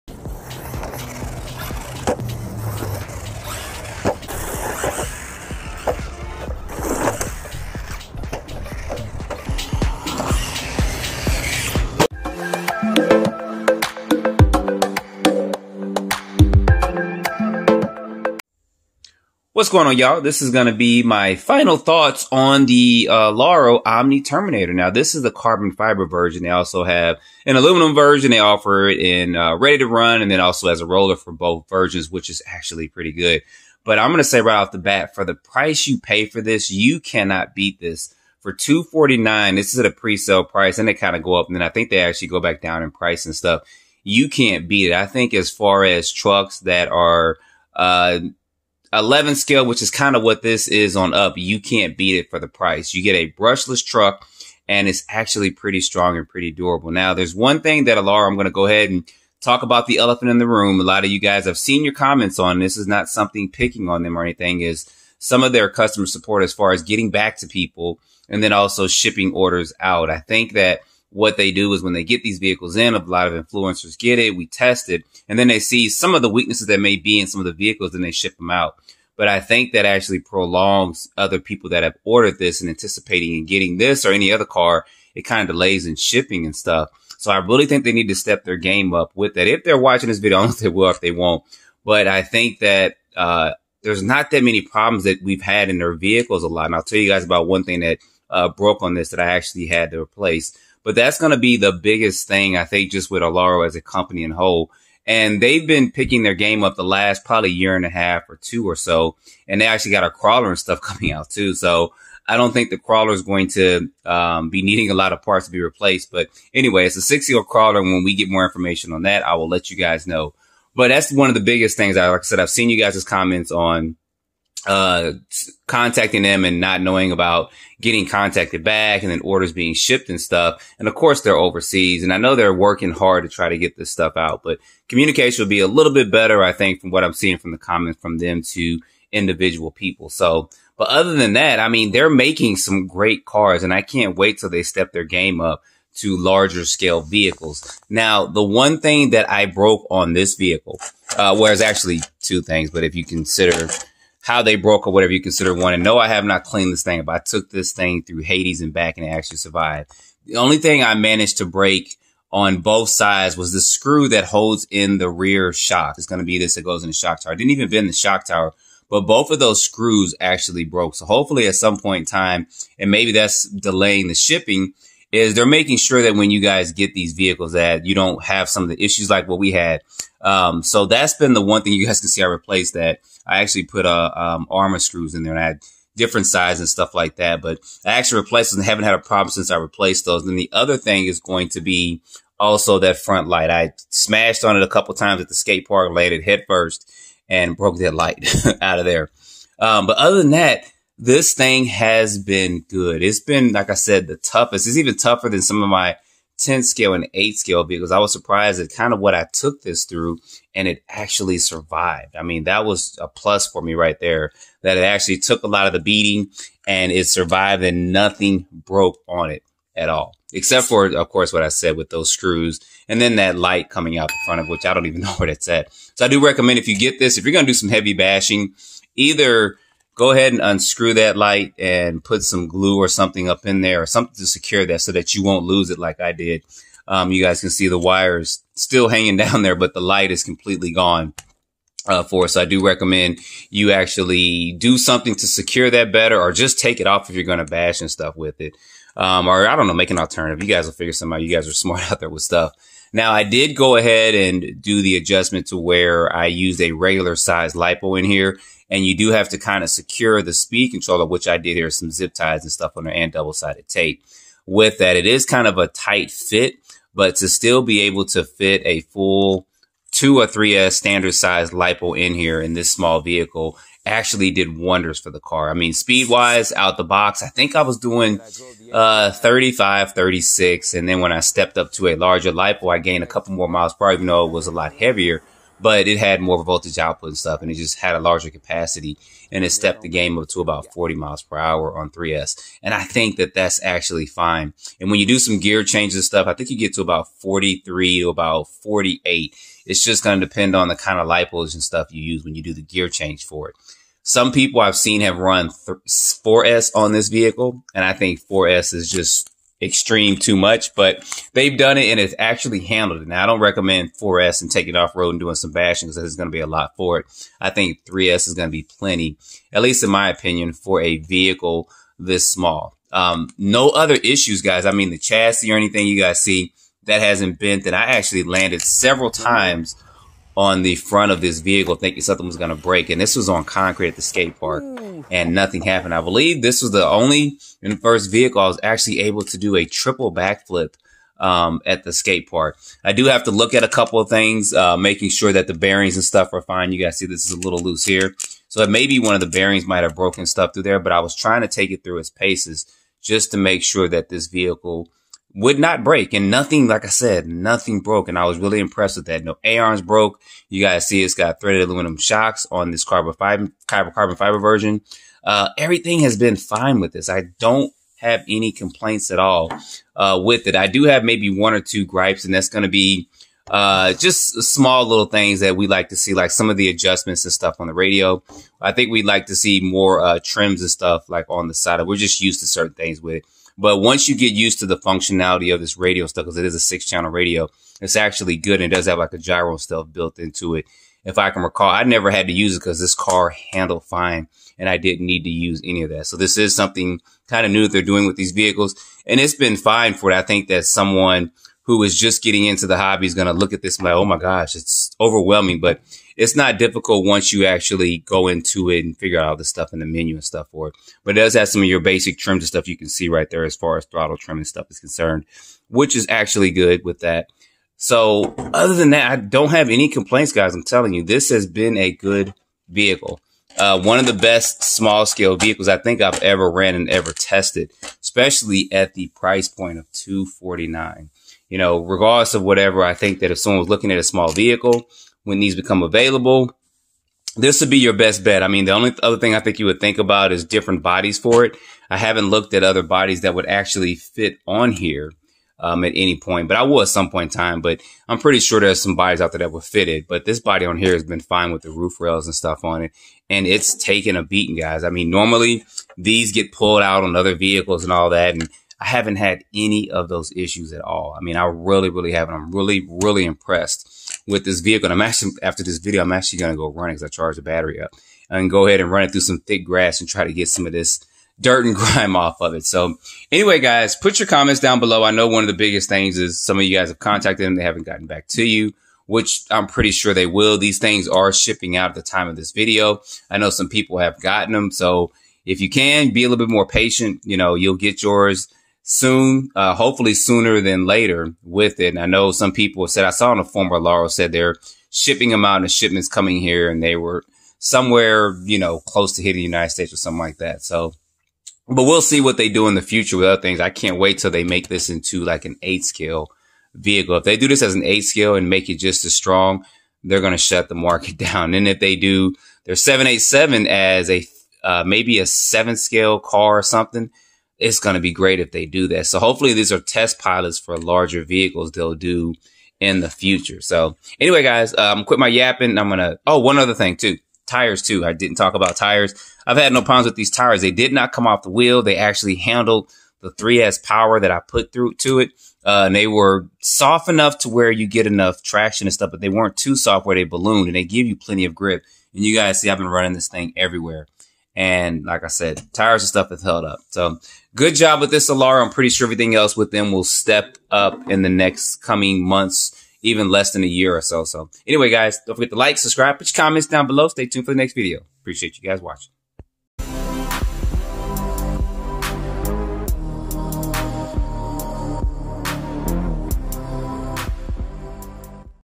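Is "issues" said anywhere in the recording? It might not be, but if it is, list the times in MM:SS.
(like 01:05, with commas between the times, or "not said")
02:58, 05:23, 07:40.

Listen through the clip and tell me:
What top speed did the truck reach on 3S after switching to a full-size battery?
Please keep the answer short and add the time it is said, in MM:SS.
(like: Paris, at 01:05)
40 mph, at 04:50.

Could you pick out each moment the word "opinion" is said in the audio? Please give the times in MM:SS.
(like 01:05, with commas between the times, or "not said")
05:20.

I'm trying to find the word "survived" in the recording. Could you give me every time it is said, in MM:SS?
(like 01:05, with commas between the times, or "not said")
02:39, 03:31, 03:37.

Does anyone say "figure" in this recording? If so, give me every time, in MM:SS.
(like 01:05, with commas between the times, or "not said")
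04:10, 06:48.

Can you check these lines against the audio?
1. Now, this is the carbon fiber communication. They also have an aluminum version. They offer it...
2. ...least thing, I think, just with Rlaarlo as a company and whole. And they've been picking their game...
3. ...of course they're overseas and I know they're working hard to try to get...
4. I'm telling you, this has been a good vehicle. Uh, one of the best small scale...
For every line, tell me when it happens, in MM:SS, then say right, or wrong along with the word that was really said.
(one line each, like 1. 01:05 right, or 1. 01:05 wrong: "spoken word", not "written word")
1. 00:24 wrong: "version", not "communication"
2. 01:41 wrong: "biggest", not "least"
3. 02:10 right
4. 07:00 right.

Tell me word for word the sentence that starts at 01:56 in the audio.
But anyway, it's a six year crawler.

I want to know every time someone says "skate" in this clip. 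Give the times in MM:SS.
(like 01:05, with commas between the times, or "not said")
03:15, 05:34, 05:41.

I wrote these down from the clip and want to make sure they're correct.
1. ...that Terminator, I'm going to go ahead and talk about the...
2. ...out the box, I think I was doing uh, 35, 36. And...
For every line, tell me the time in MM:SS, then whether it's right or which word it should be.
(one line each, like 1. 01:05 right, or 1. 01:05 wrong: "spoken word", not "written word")
1. 00:57 wrong: "Rlaarlo", not "Terminator"
2. 04:36 right.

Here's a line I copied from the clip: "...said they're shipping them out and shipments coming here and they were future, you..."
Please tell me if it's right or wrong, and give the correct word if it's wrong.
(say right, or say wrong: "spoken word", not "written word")
wrong: "somewhere", not "future".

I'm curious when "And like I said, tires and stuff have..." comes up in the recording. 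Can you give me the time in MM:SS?
09:04.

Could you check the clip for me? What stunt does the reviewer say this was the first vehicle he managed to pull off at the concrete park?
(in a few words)
triple backflip.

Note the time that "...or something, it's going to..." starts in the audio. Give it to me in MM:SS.
08:36.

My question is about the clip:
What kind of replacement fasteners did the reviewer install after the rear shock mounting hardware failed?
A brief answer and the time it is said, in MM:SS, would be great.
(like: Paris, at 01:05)
armor screws, at 03:04.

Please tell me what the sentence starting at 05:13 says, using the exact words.
Now, I don't recommend 4S and taking off road and doing some bashing because there's going to be a lot for it.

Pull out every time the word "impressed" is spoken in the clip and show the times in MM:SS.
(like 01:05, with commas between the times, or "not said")
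05:58, 07:43.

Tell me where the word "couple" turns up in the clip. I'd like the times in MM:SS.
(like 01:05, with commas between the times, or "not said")
03:14, 04:43, 05:43.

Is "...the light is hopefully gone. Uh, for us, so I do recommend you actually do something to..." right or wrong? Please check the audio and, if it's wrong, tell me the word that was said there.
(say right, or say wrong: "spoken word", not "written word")
wrong: "completely", not "hopefully".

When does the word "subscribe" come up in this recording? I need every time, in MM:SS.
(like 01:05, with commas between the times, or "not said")
09:15.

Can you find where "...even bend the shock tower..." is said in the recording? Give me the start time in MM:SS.
02:47.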